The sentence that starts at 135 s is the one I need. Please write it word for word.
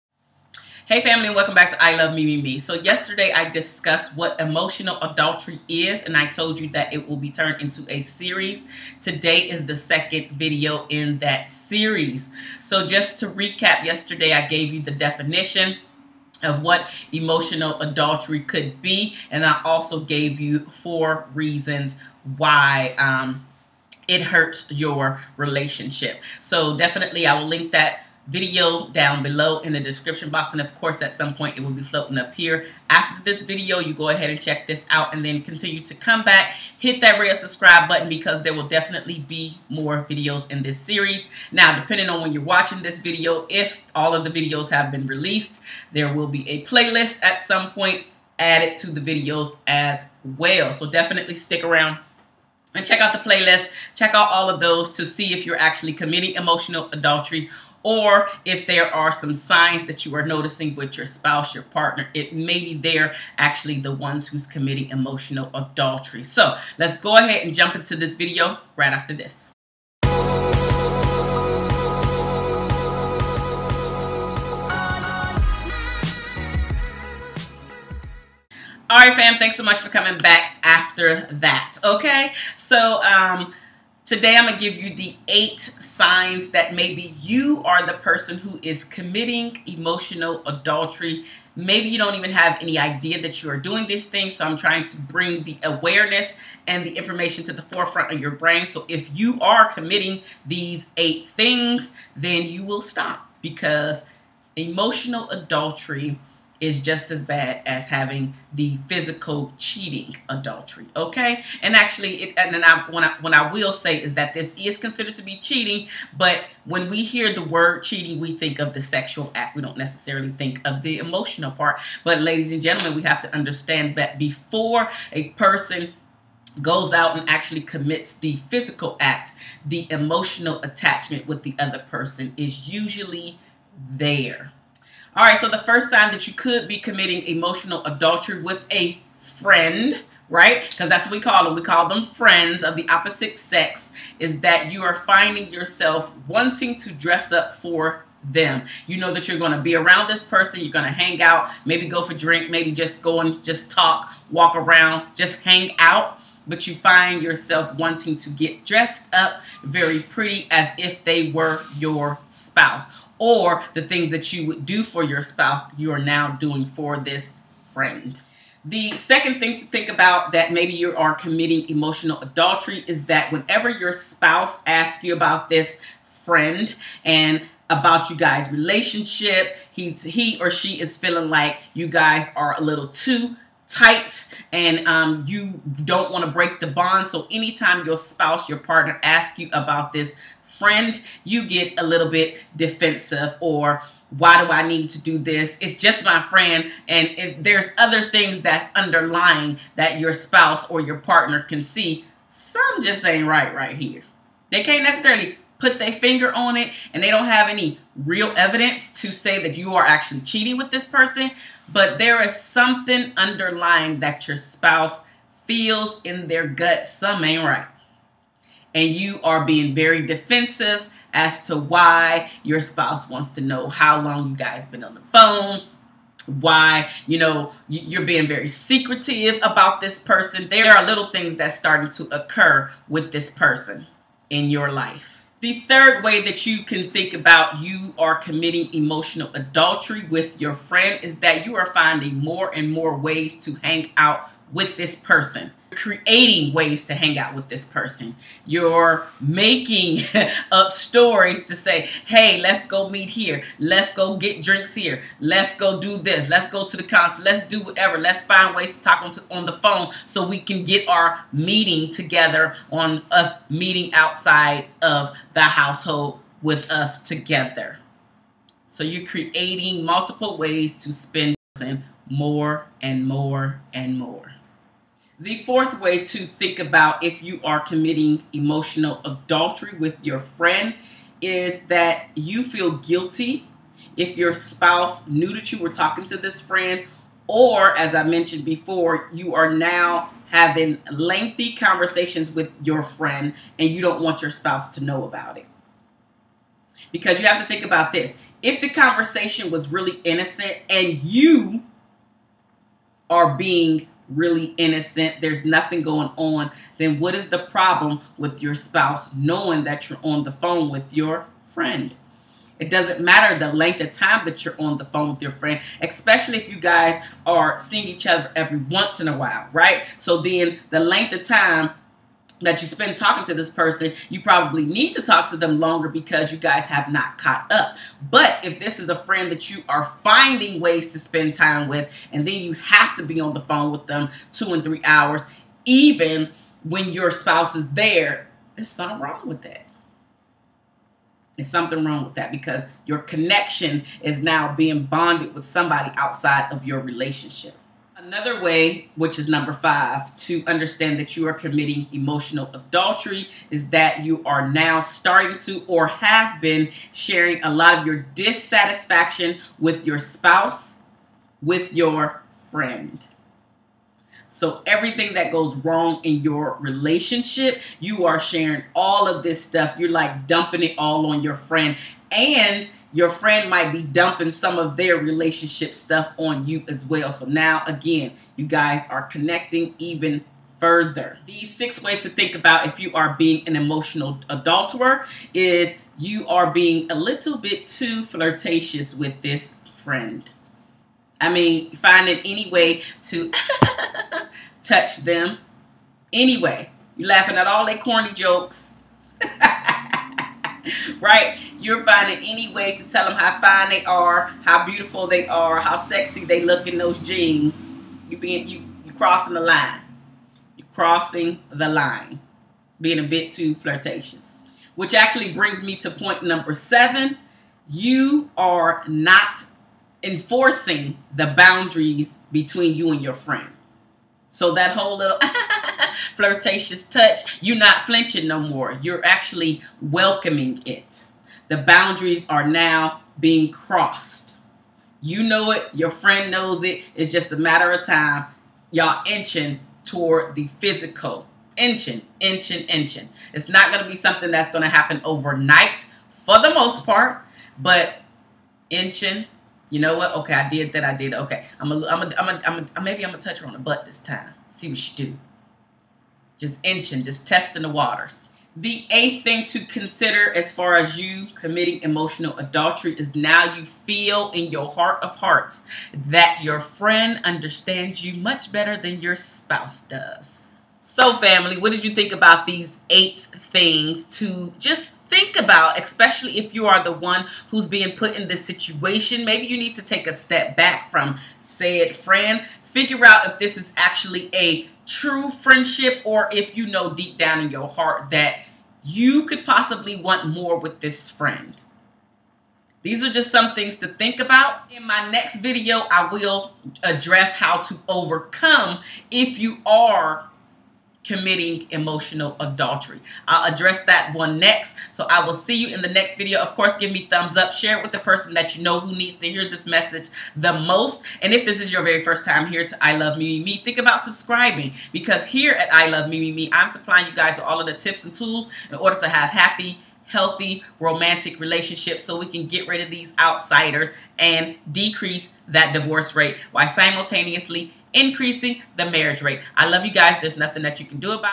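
All right, so the first sign that you could be committing emotional adultery with a friend, right?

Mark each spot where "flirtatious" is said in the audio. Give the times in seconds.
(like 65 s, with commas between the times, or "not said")
388 s, 413 s, 426 s.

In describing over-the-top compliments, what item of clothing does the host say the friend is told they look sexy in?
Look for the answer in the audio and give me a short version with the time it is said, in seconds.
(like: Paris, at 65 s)
jeans, at 406 s.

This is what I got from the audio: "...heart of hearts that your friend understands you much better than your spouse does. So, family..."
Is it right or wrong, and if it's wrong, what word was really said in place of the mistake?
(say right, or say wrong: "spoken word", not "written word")
right.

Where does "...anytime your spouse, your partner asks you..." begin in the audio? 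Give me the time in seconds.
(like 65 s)
187 s.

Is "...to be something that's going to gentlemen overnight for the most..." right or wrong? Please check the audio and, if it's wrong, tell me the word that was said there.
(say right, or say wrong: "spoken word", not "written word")
wrong: "happen", not "gentlemen".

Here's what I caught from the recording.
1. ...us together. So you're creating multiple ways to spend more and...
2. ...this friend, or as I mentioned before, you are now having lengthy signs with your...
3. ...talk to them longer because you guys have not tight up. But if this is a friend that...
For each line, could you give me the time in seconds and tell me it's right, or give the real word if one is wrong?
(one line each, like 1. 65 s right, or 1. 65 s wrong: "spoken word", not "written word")
1. 266 s right
2. 286 s wrong: "conversations", not "signs"
3. 325 s wrong: "caught", not "tight".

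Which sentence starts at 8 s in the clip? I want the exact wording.
Today is the second video in that series.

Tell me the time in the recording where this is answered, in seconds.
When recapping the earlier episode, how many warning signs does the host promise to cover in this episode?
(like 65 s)
85 s.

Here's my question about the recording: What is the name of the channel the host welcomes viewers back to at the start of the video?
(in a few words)
I Love Me Me Me.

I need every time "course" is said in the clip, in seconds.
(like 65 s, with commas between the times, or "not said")
30 s, 506 s.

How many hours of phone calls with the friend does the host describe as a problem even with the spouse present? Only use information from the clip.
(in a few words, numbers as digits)
2 and 3 hours.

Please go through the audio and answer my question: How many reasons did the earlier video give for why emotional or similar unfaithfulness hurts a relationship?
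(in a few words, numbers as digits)
4.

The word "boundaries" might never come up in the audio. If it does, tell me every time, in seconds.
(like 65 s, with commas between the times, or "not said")
421 s, 431 s.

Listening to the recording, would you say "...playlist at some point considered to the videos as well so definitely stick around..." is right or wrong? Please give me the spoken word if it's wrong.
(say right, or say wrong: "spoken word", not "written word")
wrong: "added", not "considered".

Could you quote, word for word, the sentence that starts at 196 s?
And if there's other things that's underlying that your spouse or your partner can see.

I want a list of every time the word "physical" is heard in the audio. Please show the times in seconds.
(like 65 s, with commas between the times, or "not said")
108 s, 128 s, 440 s.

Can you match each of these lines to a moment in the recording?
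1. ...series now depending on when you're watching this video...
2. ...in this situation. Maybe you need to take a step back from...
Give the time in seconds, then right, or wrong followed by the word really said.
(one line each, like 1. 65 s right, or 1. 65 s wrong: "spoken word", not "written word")
1. 40 s right
2. 478 s right.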